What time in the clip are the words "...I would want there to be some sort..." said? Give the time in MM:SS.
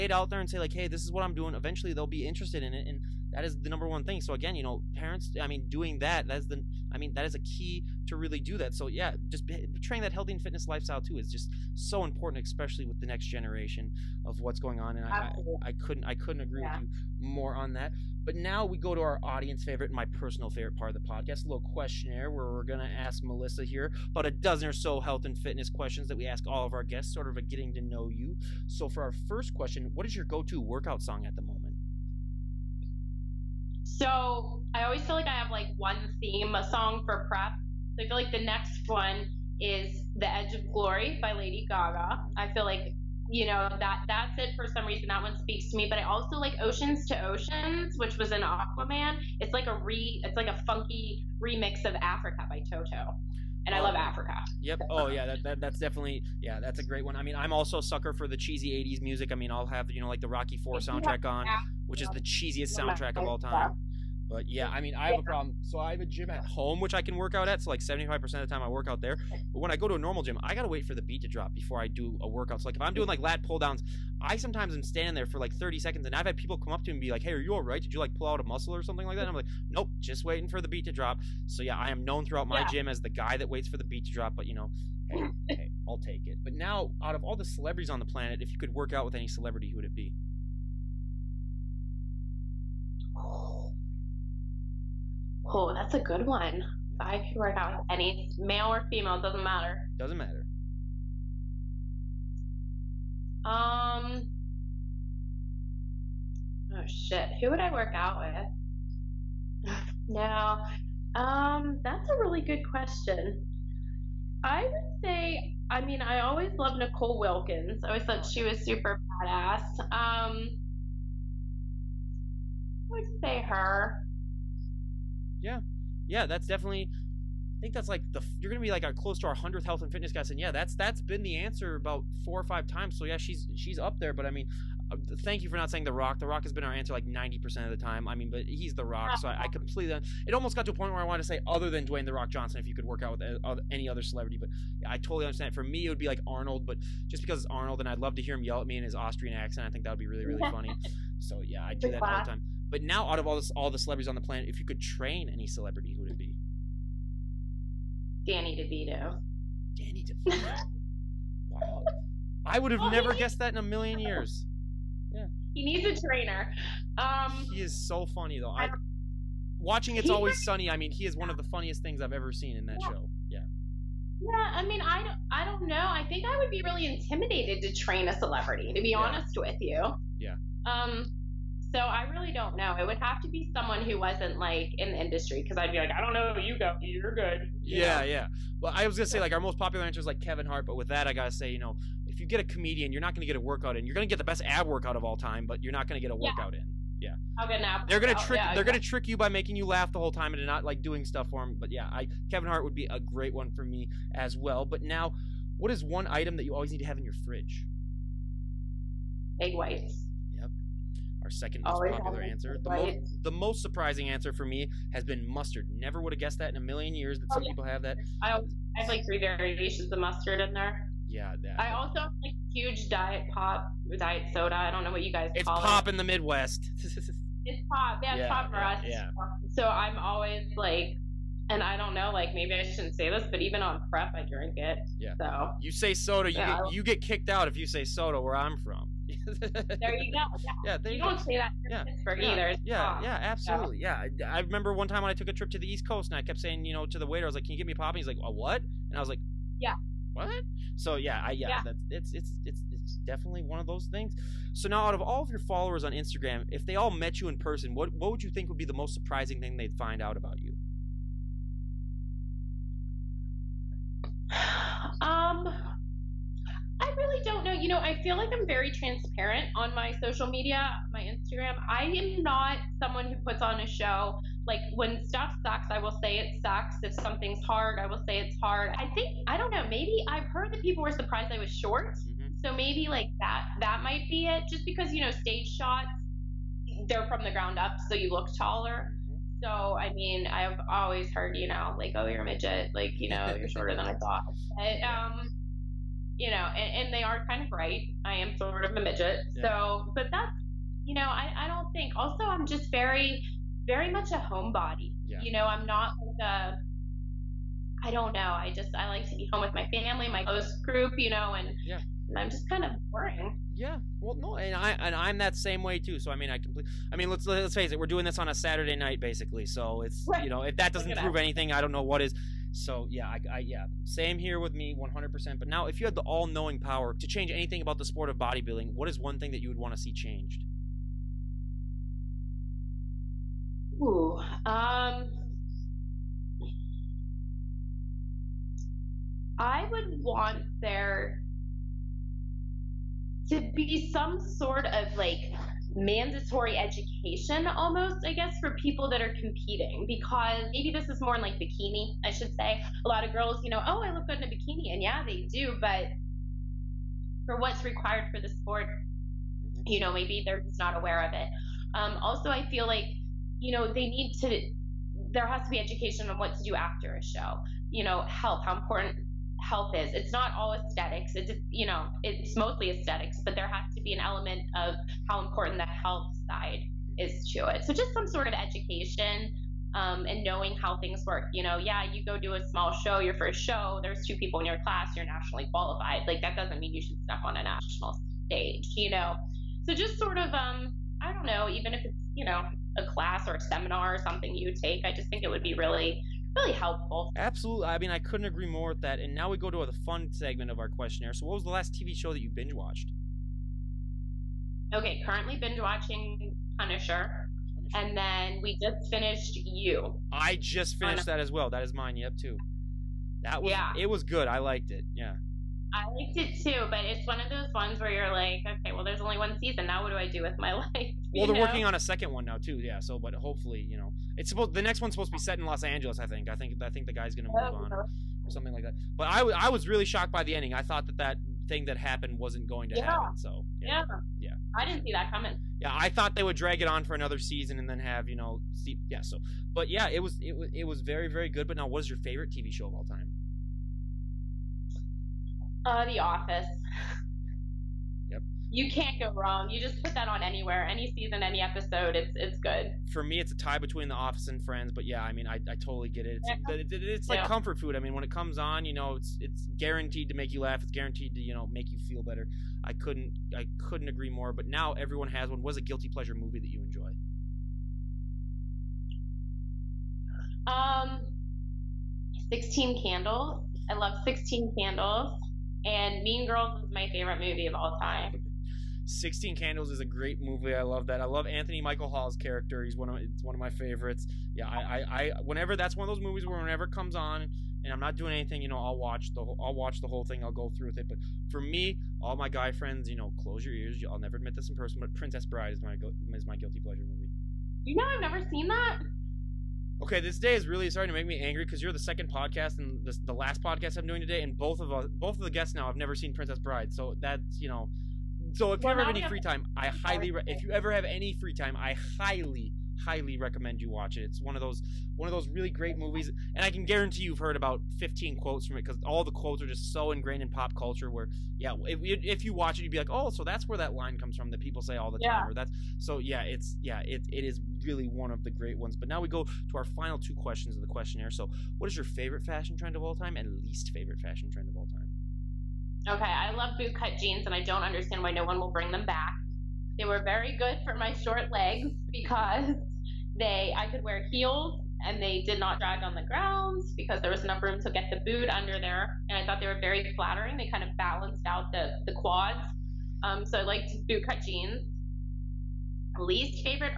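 05:39.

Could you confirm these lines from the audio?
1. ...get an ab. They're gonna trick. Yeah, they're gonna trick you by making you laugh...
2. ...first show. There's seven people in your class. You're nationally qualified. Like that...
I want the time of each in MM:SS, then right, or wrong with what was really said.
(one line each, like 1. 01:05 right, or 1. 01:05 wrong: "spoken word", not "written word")
1. 03:17 right
2. 06:23 wrong: "two", not "seven".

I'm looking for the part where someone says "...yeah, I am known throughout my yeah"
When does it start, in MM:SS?
01:21.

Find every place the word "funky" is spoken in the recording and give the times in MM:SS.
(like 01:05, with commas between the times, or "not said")
00:50.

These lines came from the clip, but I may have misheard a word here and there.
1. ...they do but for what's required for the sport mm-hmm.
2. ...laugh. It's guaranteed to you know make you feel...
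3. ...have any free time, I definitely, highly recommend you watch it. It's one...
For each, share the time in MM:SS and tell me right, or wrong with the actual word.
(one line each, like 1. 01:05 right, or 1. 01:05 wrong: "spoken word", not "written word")
1. 05:55 right
2. 07:40 right
3. 08:30 wrong: "highly", not "definitely".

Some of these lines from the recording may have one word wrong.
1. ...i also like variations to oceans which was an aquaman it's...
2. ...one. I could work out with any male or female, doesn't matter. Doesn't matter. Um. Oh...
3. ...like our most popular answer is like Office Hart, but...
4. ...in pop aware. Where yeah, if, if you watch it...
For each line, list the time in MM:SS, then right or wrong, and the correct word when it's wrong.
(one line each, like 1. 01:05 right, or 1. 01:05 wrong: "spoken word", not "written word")
1. 00:45 wrong: "oceans", not "variations"
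2. 01:36 right
3. 03:09 wrong: "Kevin", not "Office"
4. 08:40 wrong: "culture", not "aware".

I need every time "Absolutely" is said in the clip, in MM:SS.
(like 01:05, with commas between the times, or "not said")
04:03, 06:37.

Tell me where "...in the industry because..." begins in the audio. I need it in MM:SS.
03:04.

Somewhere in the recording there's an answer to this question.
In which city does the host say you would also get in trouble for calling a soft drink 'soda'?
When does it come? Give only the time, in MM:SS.
04:01.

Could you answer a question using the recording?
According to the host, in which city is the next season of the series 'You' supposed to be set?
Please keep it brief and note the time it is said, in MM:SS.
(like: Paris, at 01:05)
Los Angeles, at 07:05.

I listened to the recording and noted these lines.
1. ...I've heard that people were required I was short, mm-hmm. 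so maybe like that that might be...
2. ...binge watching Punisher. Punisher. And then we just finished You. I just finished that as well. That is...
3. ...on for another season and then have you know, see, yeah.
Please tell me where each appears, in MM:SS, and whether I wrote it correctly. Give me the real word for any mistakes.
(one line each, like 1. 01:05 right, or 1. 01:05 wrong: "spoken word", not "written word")
1. 04:40 wrong: "surprised", not "required"
2. 06:45 right
3. 07:16 right.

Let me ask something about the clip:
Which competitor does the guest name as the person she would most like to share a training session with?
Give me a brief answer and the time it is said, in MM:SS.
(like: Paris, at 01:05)
Nicole Wilkins, at 01:56.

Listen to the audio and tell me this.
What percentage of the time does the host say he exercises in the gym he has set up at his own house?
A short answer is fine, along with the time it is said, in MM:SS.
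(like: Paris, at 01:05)
75%, at 01:07.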